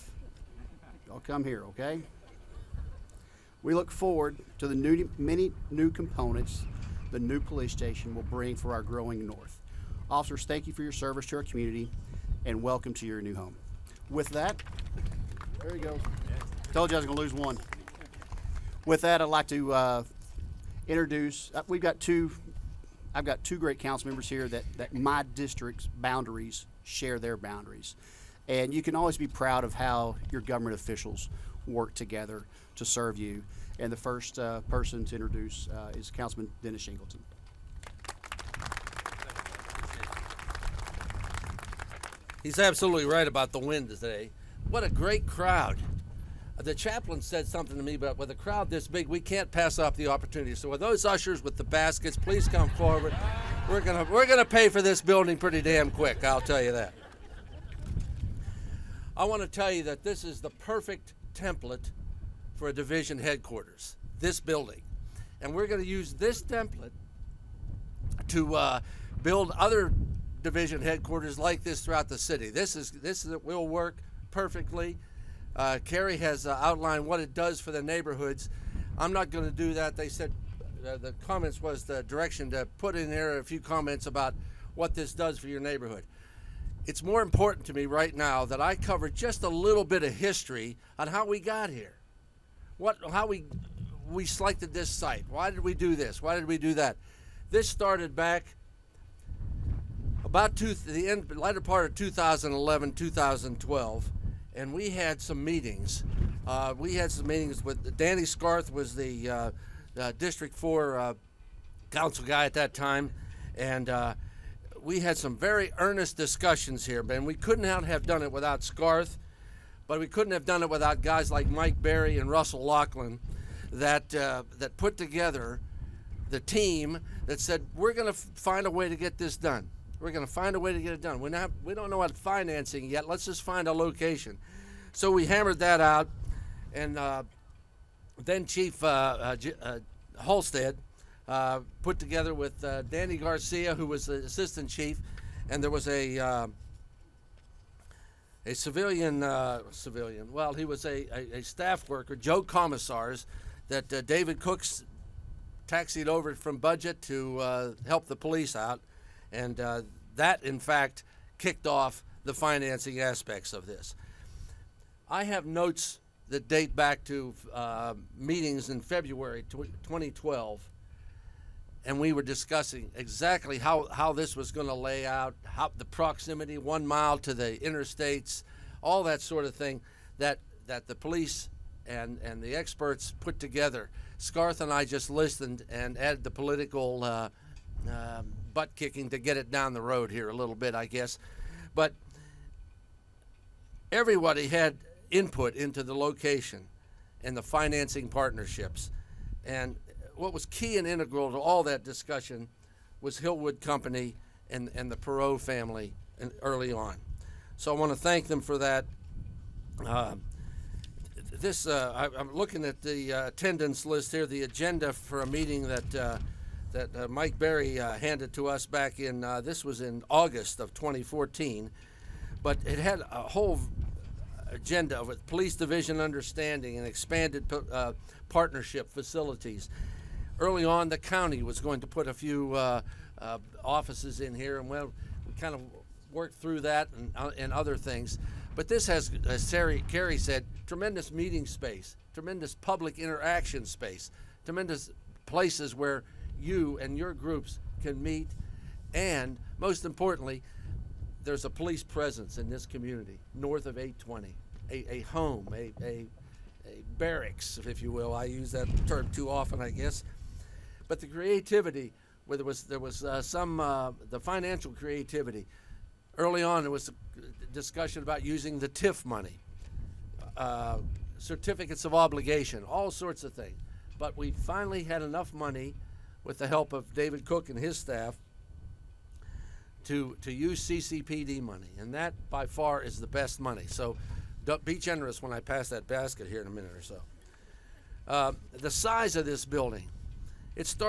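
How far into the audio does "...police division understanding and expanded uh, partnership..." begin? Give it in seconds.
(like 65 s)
225 s.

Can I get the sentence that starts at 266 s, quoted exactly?
Early on, there was a discussion about using the TIF money, uh, certificates of obligation, all sorts of things.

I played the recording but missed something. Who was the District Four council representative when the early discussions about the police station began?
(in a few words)
Danny Scarth.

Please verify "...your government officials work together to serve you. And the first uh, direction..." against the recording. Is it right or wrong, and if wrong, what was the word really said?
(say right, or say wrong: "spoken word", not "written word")
wrong: "person", not "direction".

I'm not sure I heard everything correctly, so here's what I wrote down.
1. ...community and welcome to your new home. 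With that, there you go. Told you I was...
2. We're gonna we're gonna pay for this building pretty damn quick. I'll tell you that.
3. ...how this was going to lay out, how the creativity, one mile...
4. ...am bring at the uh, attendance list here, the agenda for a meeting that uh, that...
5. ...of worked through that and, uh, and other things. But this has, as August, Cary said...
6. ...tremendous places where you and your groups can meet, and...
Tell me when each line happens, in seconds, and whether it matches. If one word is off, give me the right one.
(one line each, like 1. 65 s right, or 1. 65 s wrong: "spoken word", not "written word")
1. 11 s right
2. 53 s right
3. 173 s wrong: "proximity", not "creativity"
4. 212 s wrong: "looking", not "bring"
5. 235 s wrong: "Terry", not "August"
6. 244 s right.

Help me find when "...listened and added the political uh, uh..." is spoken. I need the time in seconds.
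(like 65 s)
185 s.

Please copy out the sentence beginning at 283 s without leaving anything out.
So, be generous when I pass that basket here in a minute or so.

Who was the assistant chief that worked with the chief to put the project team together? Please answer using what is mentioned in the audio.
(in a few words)
Danny Garcia.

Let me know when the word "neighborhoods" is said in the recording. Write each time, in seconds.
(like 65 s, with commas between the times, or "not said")
77 s, 85 s.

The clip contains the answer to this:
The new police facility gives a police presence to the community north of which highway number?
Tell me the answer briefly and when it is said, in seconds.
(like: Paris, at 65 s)
820, at 253 s.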